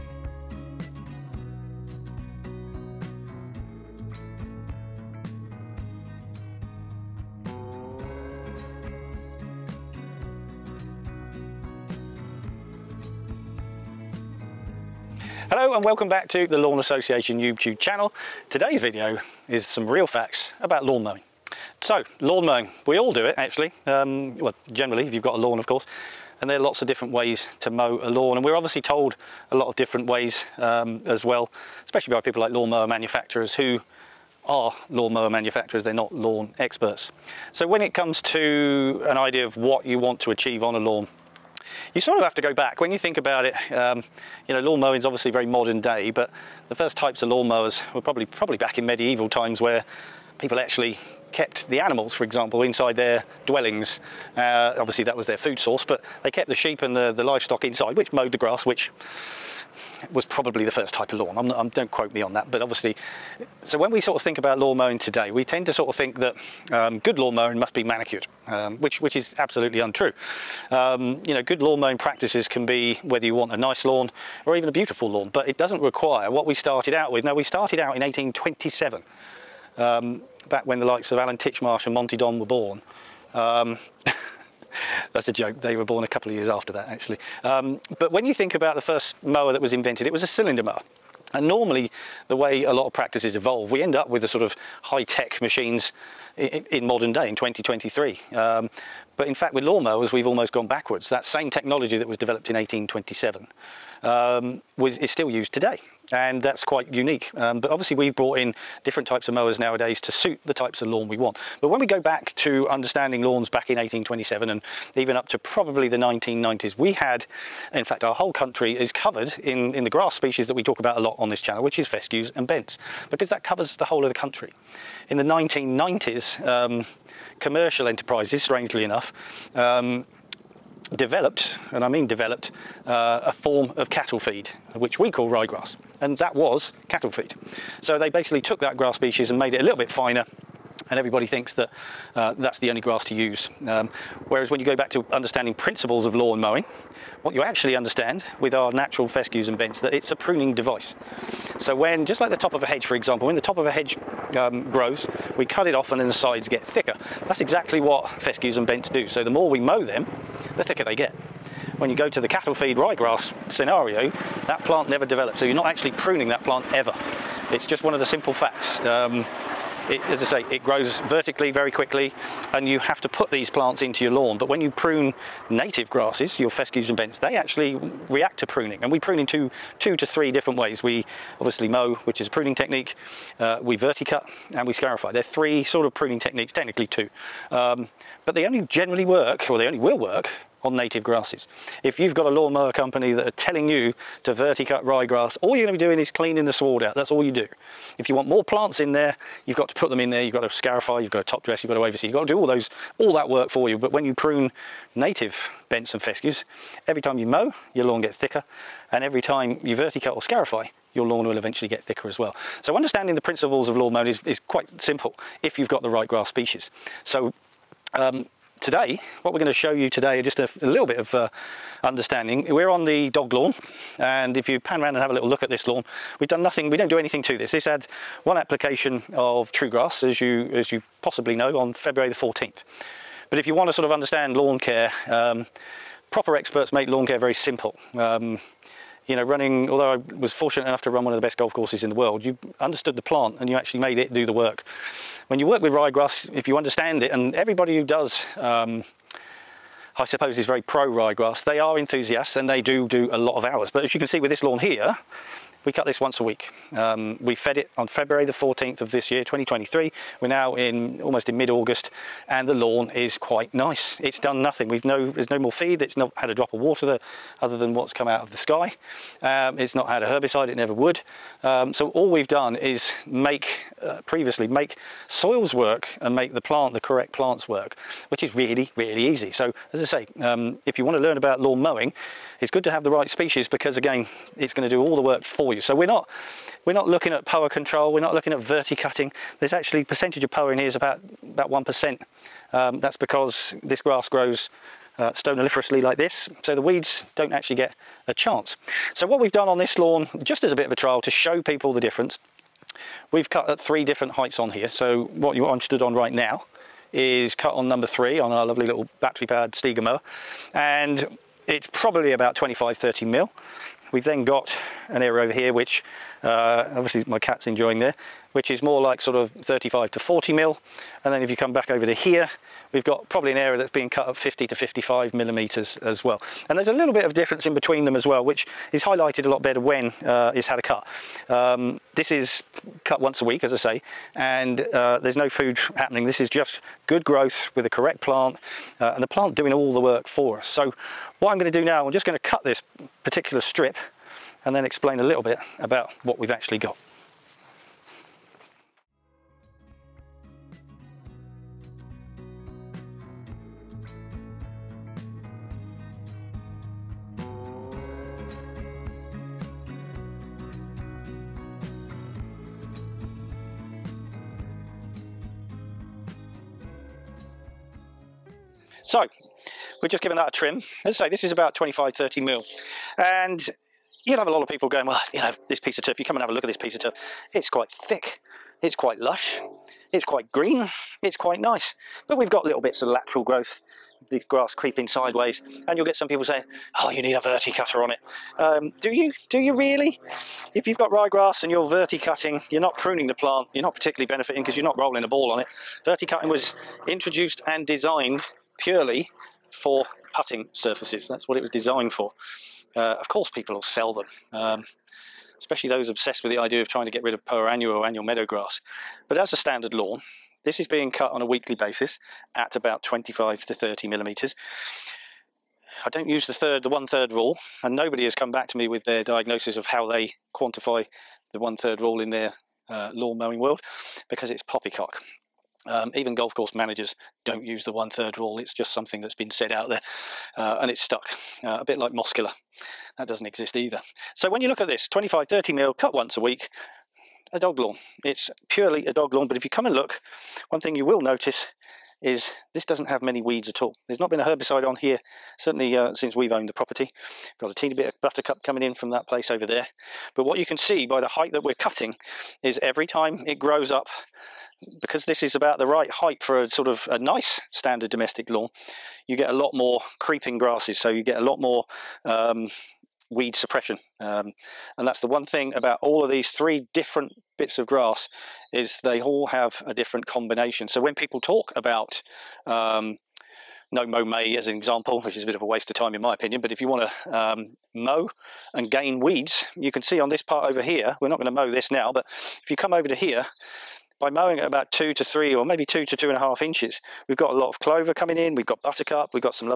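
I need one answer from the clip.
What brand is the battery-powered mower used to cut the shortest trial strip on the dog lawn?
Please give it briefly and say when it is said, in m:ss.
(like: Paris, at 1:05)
Stiga, at 5:09.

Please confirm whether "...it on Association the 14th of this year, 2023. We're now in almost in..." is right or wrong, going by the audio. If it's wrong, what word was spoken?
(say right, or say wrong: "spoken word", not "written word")
wrong: "February", not "Association".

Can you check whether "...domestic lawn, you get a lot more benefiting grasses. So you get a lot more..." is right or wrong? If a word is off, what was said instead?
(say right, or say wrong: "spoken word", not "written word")
wrong: "creeping", not "benefiting".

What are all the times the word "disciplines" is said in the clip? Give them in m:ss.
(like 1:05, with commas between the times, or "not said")
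not said.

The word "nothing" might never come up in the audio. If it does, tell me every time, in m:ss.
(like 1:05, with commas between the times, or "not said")
3:46, 4:24.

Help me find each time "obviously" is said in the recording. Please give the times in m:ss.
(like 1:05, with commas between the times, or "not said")
0:28, 0:45, 0:54, 1:02, 1:47, 3:01, 5:16.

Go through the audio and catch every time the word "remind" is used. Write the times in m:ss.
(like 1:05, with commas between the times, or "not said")
not said.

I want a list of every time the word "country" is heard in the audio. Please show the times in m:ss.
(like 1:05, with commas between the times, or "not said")
1:58, 2:04.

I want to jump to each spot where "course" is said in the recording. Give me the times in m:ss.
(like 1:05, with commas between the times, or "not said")
0:25, 4:01, 6:43, 7:06.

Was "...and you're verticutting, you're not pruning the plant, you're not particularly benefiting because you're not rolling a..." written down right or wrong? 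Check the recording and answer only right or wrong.
right.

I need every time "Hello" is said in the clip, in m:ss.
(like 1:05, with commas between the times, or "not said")
0:15.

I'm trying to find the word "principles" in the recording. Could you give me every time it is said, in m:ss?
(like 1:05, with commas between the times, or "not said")
2:25, 3:33.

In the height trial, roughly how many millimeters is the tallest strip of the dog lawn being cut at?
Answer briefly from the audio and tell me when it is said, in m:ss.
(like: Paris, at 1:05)
50 to 55 mm, at 5:24.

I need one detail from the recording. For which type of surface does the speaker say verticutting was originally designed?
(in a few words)
putting surfaces.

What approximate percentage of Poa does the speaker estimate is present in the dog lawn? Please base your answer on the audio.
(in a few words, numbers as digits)
1 percent.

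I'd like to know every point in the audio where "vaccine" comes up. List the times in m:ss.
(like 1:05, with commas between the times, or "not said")
not said.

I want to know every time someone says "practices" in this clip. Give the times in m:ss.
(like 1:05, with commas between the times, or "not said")
1:11, 1:32.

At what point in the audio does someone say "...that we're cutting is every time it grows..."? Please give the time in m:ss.
7:31.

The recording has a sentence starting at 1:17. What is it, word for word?
Now, we started out in 1827, um, back when the likes of Alan Titchmarsh and Monty Don were born.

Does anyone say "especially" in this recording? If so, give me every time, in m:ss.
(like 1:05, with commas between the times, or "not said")
0:31, 6:45.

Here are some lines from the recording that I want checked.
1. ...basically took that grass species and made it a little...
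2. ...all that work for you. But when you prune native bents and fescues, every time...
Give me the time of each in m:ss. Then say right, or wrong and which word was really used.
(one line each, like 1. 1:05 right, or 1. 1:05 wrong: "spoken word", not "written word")
1. 2:18 right
2. 3:22 right.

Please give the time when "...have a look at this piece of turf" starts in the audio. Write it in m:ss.
6:16.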